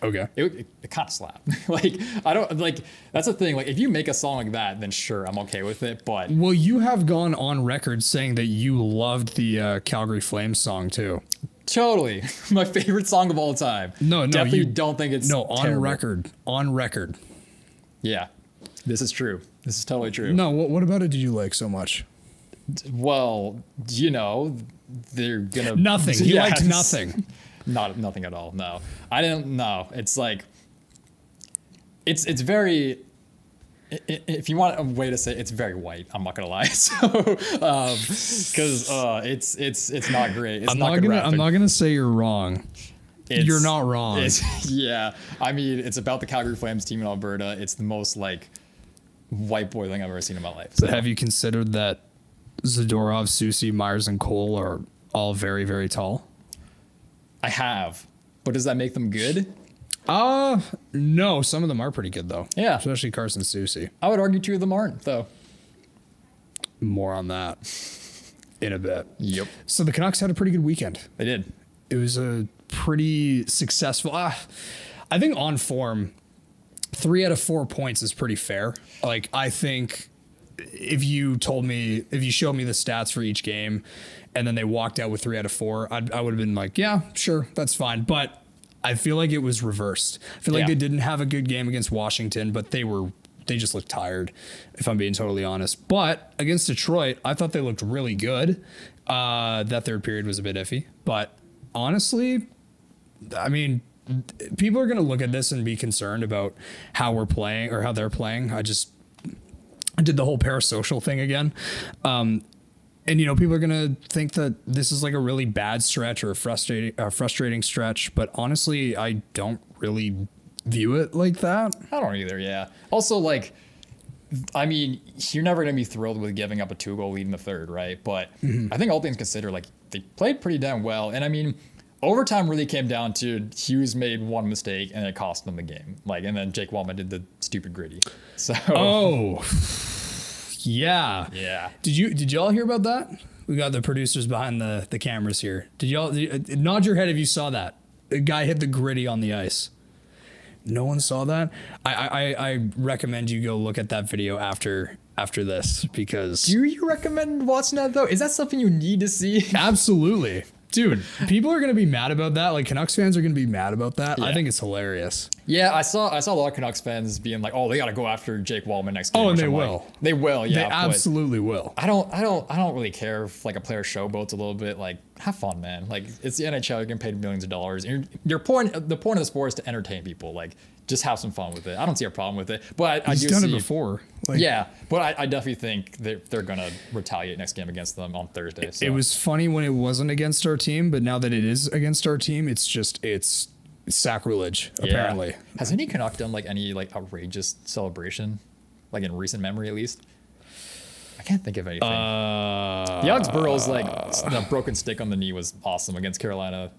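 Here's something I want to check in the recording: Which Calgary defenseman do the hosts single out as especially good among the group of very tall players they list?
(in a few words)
Carson Soucy.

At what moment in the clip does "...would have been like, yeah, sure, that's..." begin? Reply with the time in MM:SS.
01:26.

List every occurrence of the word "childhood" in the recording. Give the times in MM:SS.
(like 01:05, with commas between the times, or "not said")
not said.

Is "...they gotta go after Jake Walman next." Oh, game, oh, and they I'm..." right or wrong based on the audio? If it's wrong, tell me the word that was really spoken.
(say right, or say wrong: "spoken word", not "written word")
right.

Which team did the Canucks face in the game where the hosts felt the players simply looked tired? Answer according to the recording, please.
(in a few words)
Washington.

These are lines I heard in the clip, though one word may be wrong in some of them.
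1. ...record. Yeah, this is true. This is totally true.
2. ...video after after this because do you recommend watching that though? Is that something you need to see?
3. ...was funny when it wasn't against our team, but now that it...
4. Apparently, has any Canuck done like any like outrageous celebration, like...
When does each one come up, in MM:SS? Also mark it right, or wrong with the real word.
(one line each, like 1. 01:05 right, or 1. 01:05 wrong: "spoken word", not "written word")
1. 00:16 right
2. 02:34 right
3. 03:08 right
4. 03:14 right.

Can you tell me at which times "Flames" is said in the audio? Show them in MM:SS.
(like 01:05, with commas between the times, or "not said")
00:10, 00:46.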